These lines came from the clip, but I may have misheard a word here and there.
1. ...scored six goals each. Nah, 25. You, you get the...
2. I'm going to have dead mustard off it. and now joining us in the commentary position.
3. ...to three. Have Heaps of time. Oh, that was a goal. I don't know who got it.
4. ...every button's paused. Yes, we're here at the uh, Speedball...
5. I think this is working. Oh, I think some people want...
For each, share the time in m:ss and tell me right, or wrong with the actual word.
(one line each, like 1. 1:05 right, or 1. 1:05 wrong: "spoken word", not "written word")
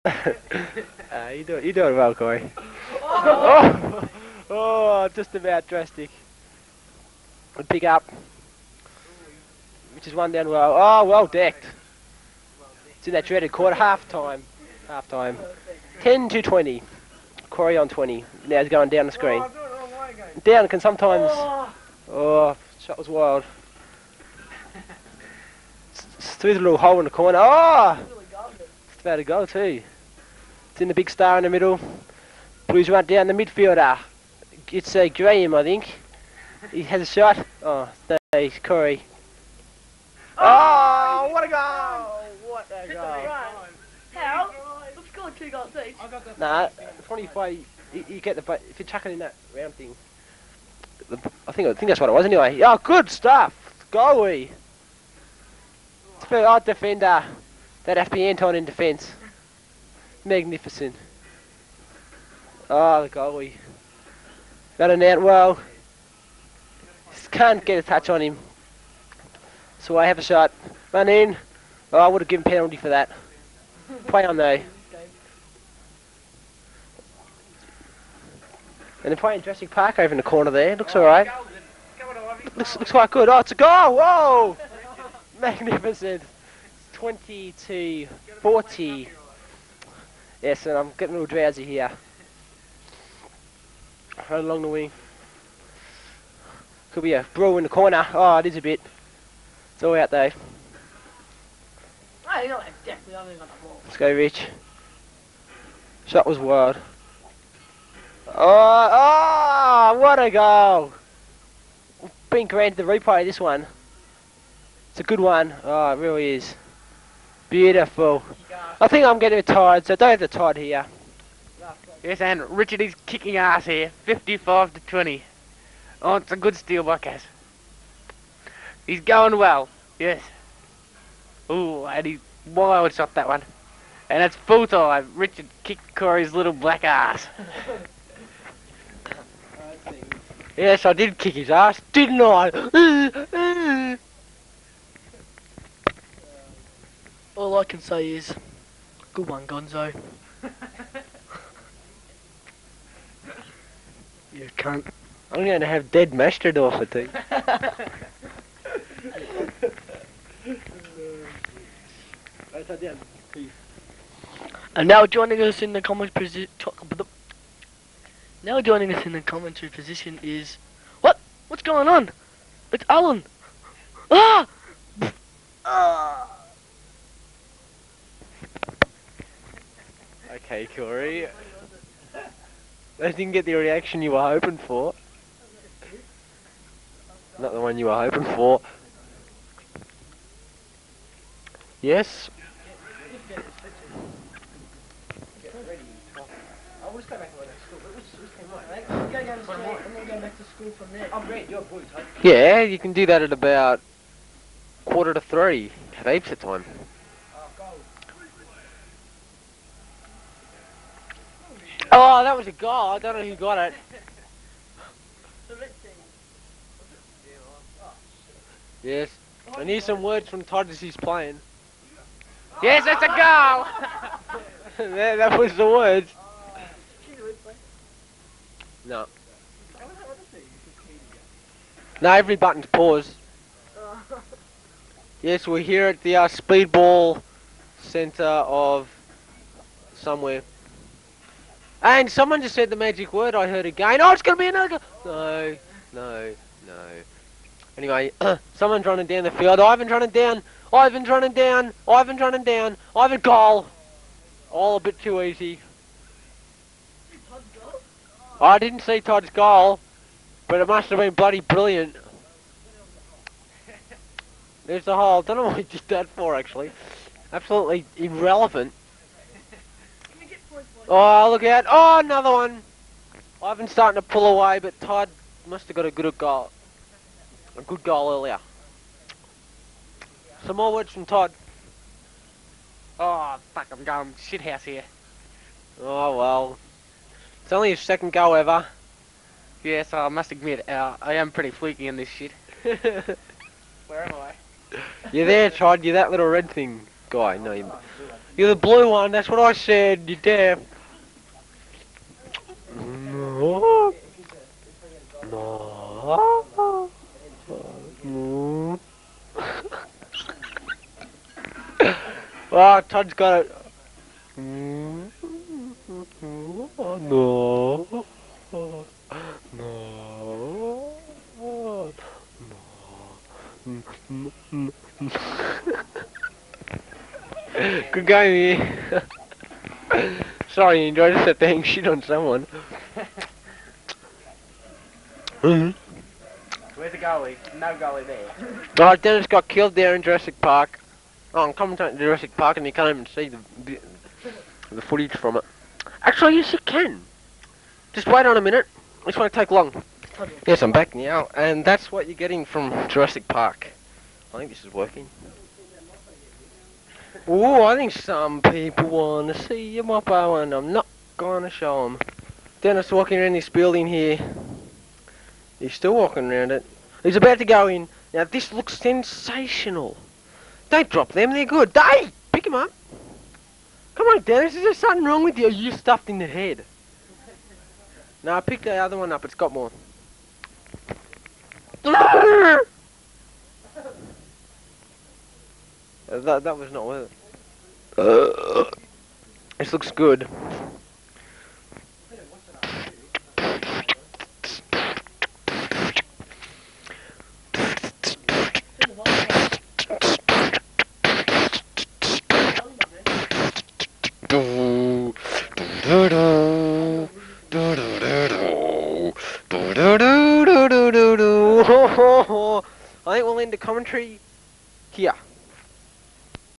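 1. 0:45 wrong: "two", not "six"
2. 2:35 right
3. 3:25 right
4. 3:52 right
5. 5:54 right.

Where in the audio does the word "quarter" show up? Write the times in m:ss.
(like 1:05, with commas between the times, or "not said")
0:13, 3:24.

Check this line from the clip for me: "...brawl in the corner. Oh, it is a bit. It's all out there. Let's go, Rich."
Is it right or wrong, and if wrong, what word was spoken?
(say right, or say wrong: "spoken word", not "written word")
right.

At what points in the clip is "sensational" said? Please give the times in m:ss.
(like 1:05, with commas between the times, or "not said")
6:08.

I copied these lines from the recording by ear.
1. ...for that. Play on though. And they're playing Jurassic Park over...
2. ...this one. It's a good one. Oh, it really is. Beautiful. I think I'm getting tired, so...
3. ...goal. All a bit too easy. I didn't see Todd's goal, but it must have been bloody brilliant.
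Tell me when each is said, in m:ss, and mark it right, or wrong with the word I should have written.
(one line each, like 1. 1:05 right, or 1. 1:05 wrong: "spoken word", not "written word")
1. 1:12 right
2. 1:53 right
3. 4:13 right.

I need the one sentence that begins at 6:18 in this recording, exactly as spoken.
No, I picked the other one up.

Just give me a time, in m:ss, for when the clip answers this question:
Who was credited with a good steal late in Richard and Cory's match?
2:06.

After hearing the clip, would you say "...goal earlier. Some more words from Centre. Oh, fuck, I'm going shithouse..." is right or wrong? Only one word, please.
wrong.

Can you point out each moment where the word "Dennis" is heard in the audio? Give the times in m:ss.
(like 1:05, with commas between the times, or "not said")
5:39, 6:02, 6:14.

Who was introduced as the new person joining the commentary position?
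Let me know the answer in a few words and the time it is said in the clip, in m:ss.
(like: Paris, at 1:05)
Alan, at 2:52.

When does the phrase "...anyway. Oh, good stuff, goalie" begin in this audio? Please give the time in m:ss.
0:52.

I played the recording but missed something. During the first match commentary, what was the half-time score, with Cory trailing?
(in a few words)
10 to 20.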